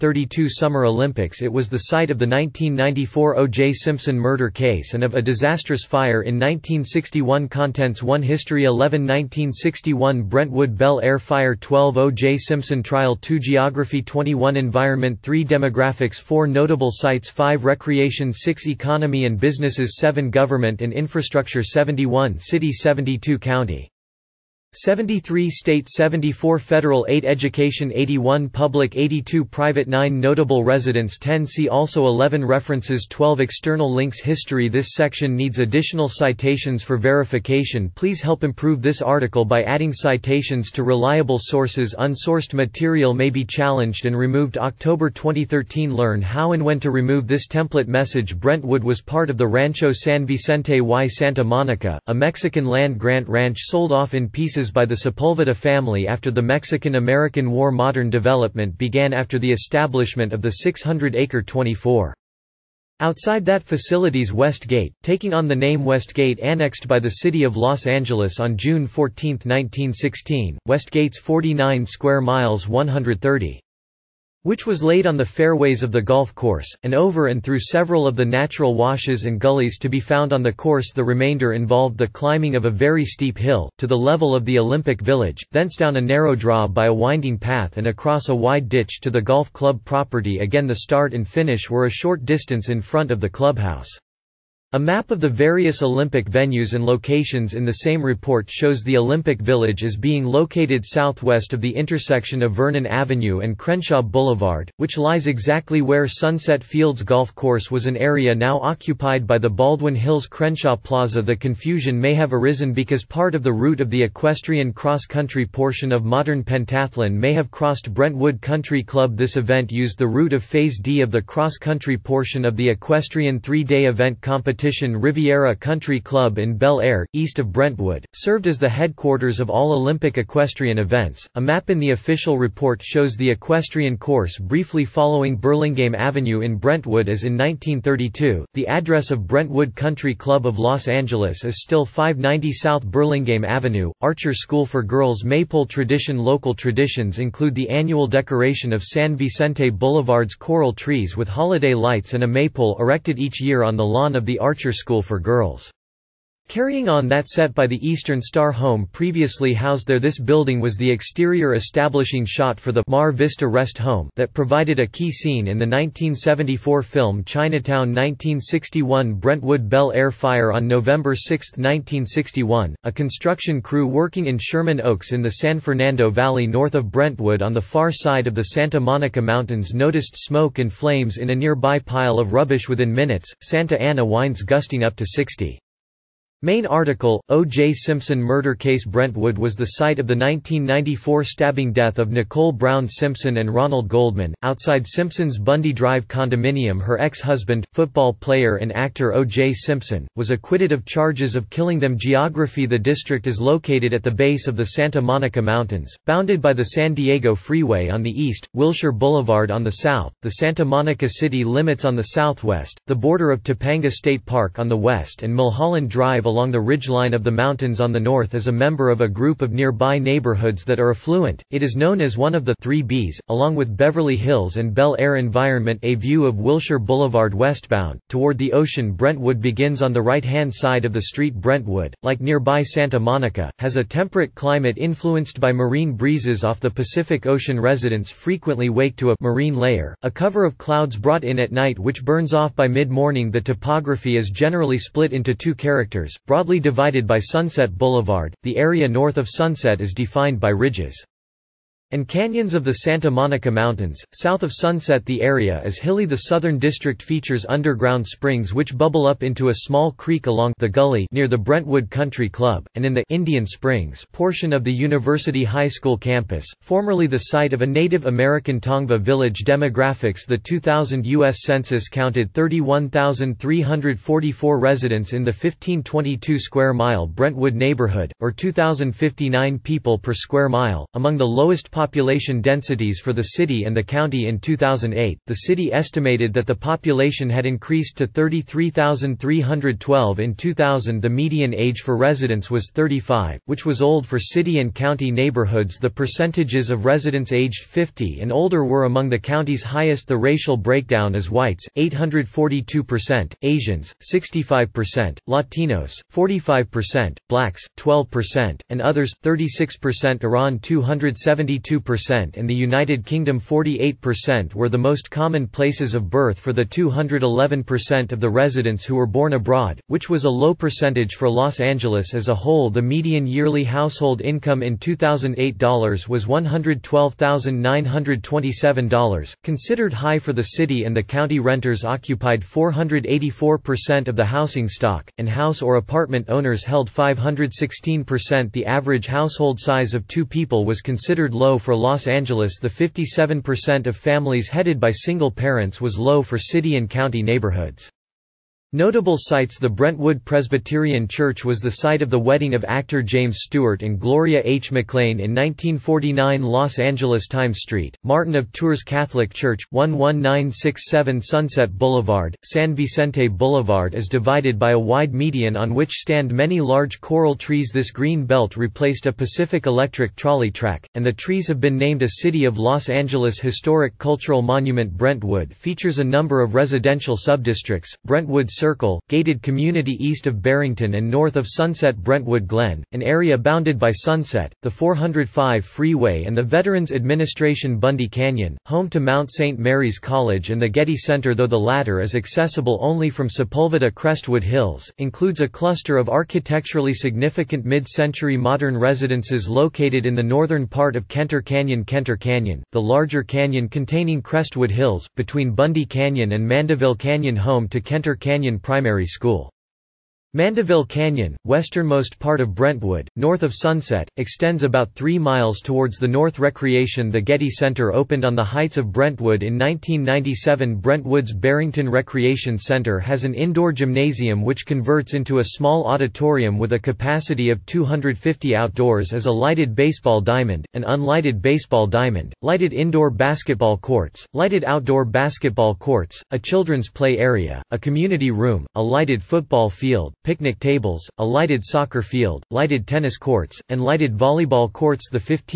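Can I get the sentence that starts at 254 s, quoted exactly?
South of Sunset, the area is hilly.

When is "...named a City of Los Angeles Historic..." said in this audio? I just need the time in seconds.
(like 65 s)
371 s.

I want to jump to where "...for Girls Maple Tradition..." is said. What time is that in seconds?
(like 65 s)
144 s.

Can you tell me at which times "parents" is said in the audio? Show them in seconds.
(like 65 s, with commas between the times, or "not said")
345 s.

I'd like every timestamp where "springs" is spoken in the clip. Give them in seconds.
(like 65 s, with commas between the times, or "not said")
258 s, 263 s.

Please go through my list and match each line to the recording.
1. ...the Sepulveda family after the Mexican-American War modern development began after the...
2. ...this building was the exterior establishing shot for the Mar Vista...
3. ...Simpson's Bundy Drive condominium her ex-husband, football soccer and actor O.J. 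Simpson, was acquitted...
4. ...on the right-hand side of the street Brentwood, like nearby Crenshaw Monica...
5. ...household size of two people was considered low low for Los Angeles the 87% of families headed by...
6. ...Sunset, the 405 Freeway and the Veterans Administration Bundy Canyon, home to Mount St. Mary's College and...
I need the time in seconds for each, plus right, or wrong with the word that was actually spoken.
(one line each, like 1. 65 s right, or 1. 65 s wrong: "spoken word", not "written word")
1. 54 s right
2. 159 s right
3. 194 s wrong: "player", not "soccer"
4. 229 s wrong: "Santa", not "Crenshaw"
5. 339 s wrong: "57", not "87"
6. 383 s right.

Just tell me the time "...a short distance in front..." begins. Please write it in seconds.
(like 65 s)
91 s.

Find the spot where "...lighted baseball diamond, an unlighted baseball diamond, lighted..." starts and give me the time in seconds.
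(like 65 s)
429 s.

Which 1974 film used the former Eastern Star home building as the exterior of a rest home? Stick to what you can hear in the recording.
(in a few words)
Chinatown.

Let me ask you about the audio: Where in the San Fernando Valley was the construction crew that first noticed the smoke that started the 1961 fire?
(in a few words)
Sherman Oaks.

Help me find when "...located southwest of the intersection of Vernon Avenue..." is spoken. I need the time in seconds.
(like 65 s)
100 s.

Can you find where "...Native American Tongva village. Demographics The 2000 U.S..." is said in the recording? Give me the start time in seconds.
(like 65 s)
267 s.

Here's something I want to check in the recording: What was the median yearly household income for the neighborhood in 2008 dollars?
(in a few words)
$112,927.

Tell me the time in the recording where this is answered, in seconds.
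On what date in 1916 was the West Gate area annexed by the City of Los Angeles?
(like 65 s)
68 s.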